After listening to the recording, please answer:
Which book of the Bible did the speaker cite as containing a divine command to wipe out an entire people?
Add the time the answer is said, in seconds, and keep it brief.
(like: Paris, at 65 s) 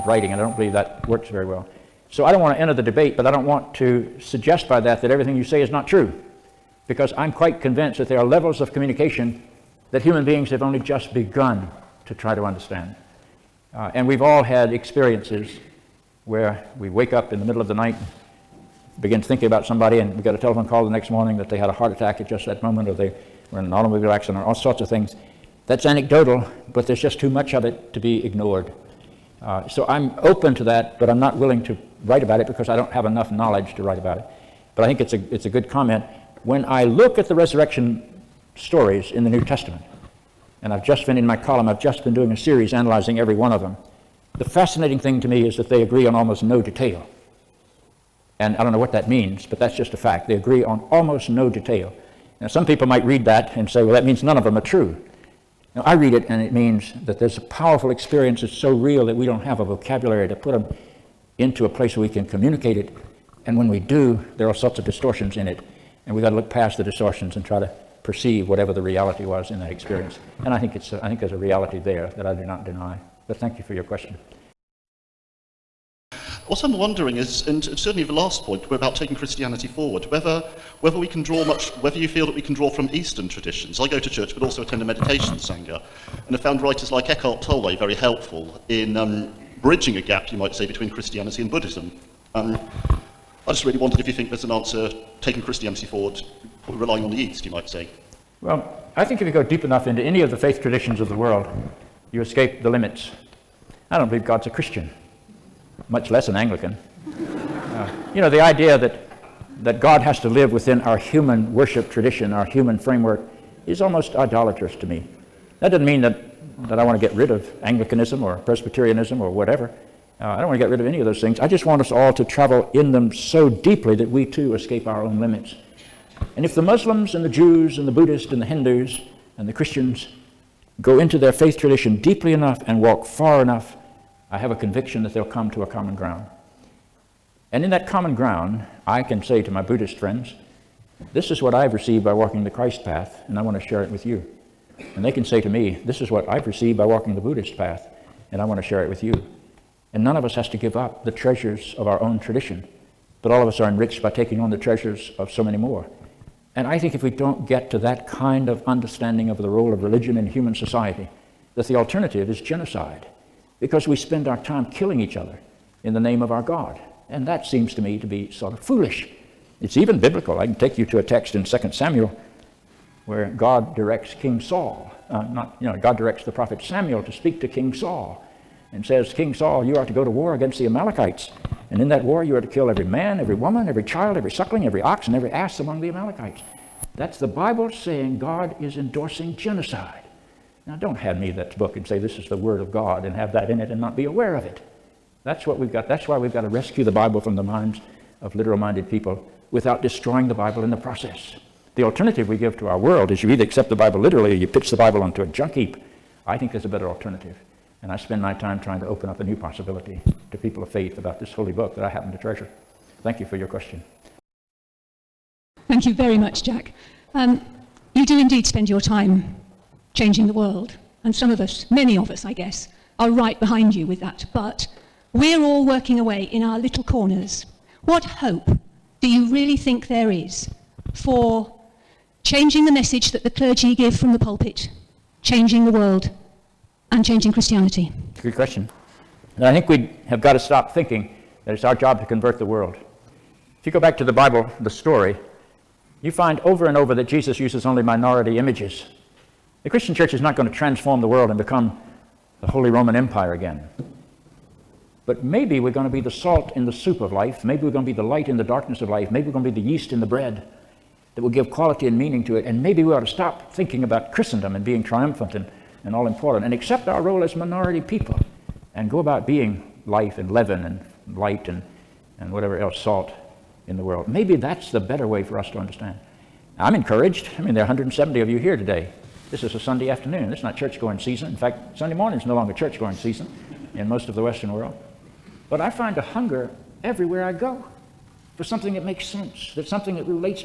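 2 Samuel, at 171 s.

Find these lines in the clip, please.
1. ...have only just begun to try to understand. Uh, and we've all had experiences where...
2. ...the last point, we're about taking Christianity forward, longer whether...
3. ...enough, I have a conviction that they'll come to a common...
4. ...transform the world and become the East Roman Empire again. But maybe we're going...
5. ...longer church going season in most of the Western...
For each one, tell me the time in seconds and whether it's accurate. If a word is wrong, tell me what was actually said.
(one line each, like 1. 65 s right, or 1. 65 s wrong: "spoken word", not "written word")
1. 10 s right
2. 78 s wrong: "whether", not "longer"
3. 133 s right
4. 250 s wrong: "Holy", not "East"
5. 282 s right.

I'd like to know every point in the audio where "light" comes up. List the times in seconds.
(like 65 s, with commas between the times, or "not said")
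258 s, 271 s.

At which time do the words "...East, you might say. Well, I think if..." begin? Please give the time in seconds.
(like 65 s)
97 s.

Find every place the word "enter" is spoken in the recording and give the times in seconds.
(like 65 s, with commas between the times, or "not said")
2 s.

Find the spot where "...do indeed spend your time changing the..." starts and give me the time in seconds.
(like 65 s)
218 s.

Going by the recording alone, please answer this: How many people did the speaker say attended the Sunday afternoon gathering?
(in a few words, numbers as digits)
170.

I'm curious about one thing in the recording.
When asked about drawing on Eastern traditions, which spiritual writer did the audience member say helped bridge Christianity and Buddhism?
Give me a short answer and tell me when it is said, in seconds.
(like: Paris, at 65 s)
Eckhart Tolle, at 87 s.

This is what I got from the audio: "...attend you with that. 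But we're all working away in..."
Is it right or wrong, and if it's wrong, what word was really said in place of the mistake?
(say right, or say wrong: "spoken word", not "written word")
wrong: "behind", not "attend".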